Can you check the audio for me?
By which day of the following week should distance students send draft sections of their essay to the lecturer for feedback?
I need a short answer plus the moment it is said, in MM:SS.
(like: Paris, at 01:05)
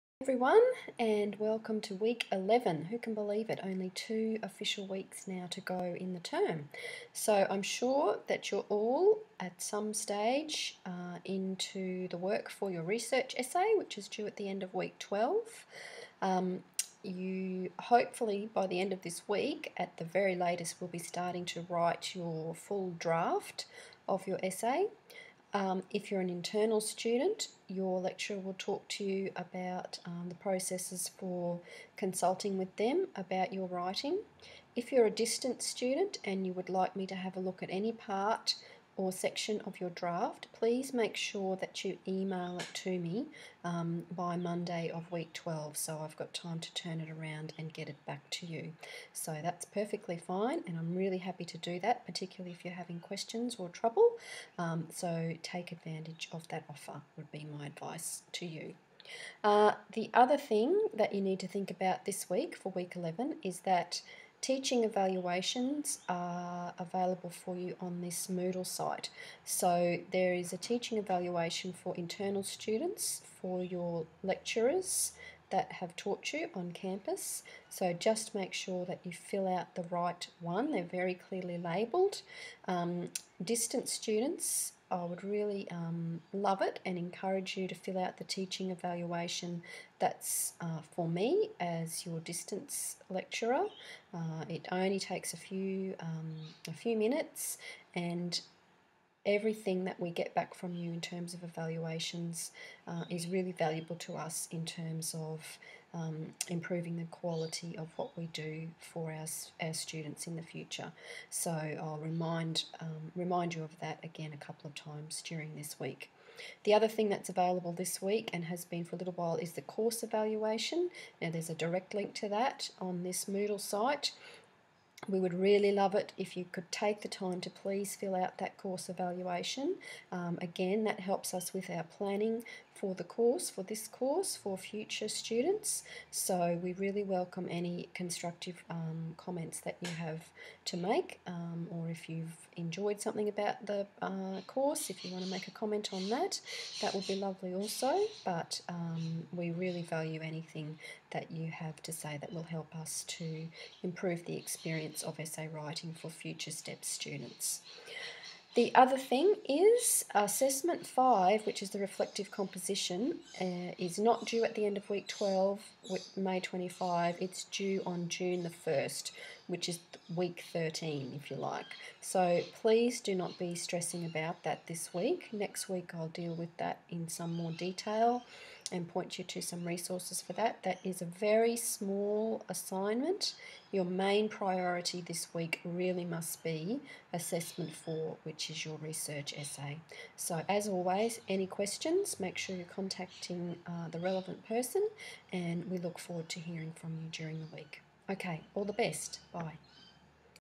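Monday of week 12, at 00:44.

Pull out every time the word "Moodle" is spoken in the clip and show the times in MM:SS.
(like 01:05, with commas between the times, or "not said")
01:08, 02:03.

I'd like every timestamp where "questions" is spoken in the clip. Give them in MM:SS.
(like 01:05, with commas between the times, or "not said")
00:52, 03:11.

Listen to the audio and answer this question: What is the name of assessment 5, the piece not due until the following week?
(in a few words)
reflective composition.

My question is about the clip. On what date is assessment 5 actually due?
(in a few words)
June 1.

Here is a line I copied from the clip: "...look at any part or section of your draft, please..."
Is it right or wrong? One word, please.
right.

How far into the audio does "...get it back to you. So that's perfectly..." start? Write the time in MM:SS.
00:47.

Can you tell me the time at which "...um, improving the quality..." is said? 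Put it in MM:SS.
01:45.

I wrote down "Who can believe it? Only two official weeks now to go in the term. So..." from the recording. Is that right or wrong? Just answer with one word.
right.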